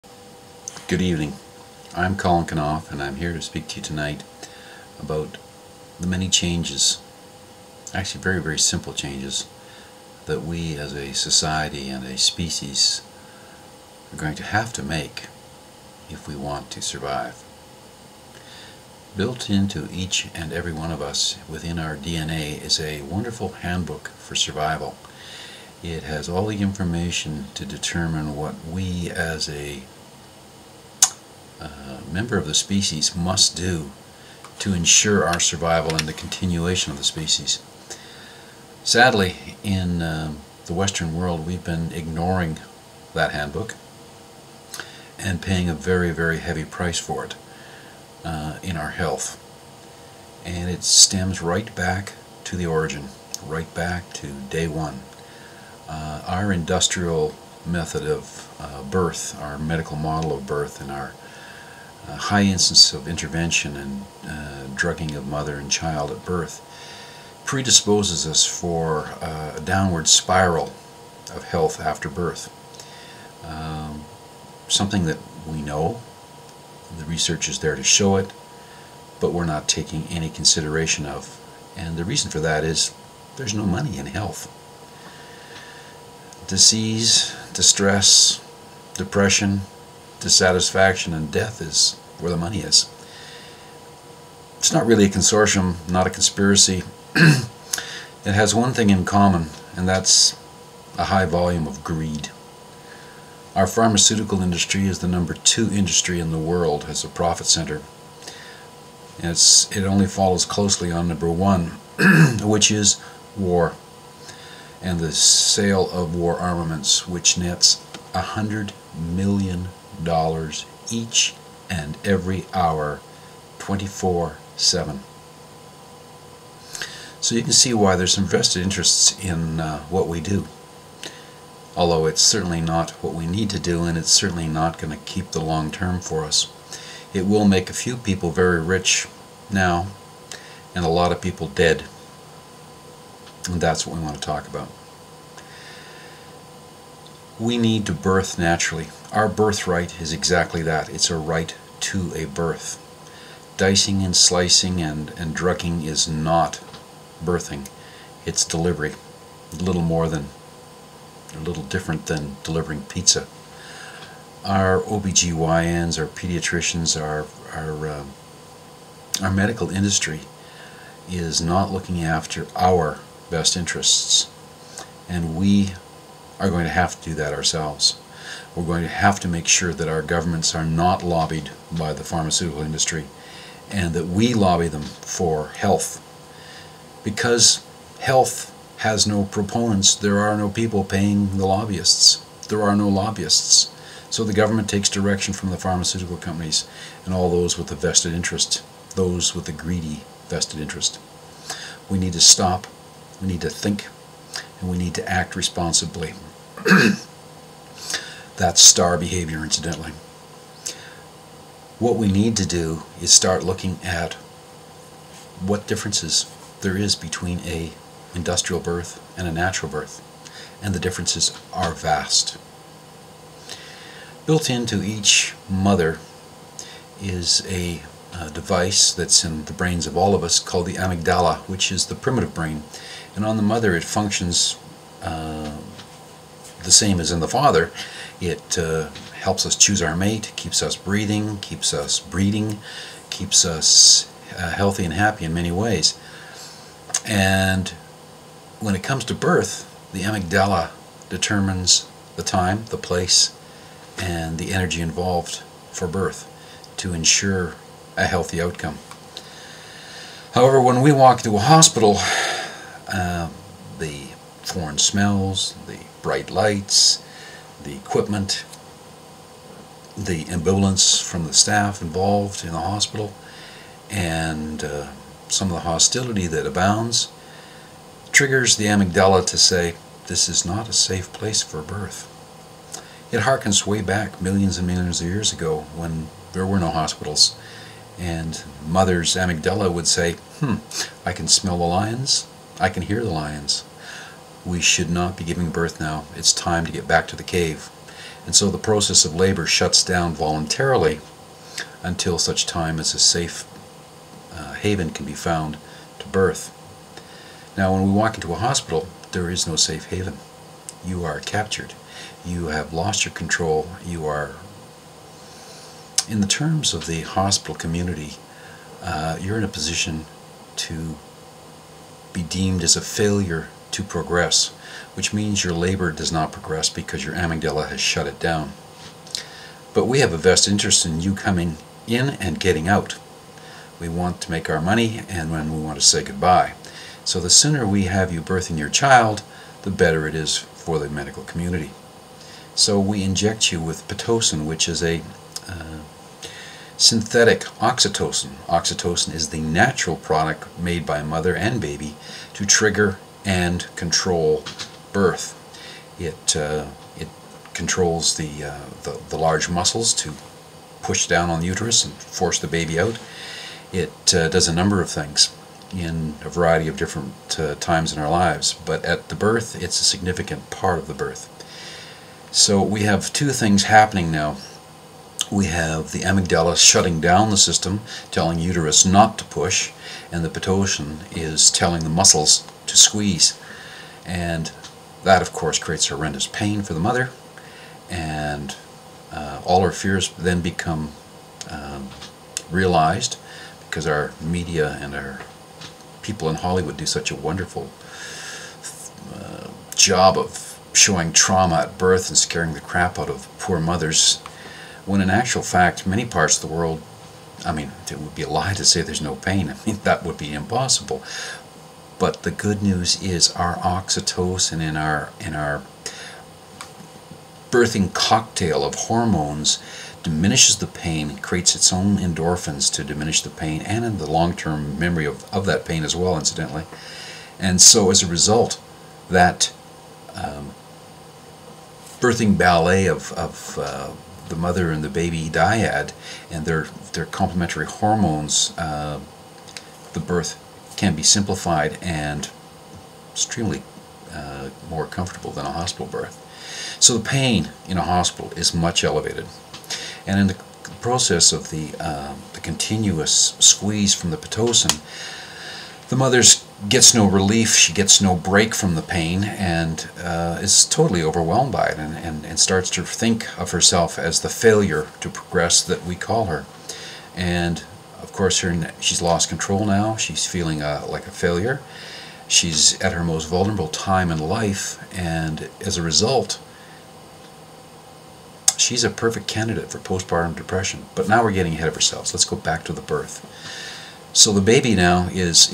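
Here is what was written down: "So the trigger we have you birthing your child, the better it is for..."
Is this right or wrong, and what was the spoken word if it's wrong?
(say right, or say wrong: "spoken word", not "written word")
wrong: "sooner", not "trigger".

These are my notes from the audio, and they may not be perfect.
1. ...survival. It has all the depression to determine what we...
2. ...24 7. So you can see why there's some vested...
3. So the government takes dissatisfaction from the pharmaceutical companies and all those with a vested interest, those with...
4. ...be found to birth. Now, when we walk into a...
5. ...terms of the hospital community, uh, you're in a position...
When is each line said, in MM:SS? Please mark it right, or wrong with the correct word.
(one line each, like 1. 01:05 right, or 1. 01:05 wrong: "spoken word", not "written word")
1. 00:24 wrong: "information", not "depression"
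2. 02:03 right
3. 03:14 wrong: "direction", not "dissatisfaction"
4. 05:05 right
5. 05:16 right.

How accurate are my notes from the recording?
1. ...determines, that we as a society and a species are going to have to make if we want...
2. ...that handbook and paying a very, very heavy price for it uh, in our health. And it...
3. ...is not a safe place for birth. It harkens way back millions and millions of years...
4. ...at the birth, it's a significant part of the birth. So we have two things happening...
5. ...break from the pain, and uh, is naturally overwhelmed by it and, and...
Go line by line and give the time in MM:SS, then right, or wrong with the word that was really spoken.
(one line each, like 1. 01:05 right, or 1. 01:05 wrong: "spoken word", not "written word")
1. 00:08 wrong: "changes", not "determines"
2. 00:43 right
3. 04:40 right
4. 06:08 right
5. 07:38 wrong: "totally", not "naturally".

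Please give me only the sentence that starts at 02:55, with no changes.
And we are going to have to do that ourselves.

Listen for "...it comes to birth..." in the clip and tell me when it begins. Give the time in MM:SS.
04:08.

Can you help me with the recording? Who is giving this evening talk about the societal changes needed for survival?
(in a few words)
Colin Knauf.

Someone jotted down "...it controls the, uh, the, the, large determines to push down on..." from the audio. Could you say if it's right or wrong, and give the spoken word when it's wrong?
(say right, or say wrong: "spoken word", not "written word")
wrong: "muscles", not "determines".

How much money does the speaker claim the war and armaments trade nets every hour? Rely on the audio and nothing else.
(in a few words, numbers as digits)
100 million dollars.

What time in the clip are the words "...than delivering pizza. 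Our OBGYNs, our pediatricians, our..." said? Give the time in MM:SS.
02:42.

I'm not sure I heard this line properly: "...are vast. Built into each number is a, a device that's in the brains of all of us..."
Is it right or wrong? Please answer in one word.
wrong.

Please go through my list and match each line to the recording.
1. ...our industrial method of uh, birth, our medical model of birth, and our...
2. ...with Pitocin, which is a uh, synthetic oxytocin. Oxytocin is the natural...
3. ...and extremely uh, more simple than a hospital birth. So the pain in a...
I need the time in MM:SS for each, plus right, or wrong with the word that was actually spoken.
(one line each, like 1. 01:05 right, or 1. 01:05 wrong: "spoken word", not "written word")
1. 00:56 right
2. 05:43 right
3. 07:21 wrong: "comfortable", not "simple".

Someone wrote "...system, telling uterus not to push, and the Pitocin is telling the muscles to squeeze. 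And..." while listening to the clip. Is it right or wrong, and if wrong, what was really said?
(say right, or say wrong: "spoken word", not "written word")
right.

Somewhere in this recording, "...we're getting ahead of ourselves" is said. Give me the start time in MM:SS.
08:01.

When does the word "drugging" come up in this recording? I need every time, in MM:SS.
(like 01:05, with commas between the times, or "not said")
01:04, 02:35.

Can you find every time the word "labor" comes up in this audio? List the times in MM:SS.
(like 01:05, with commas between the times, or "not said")
04:59, 05:25.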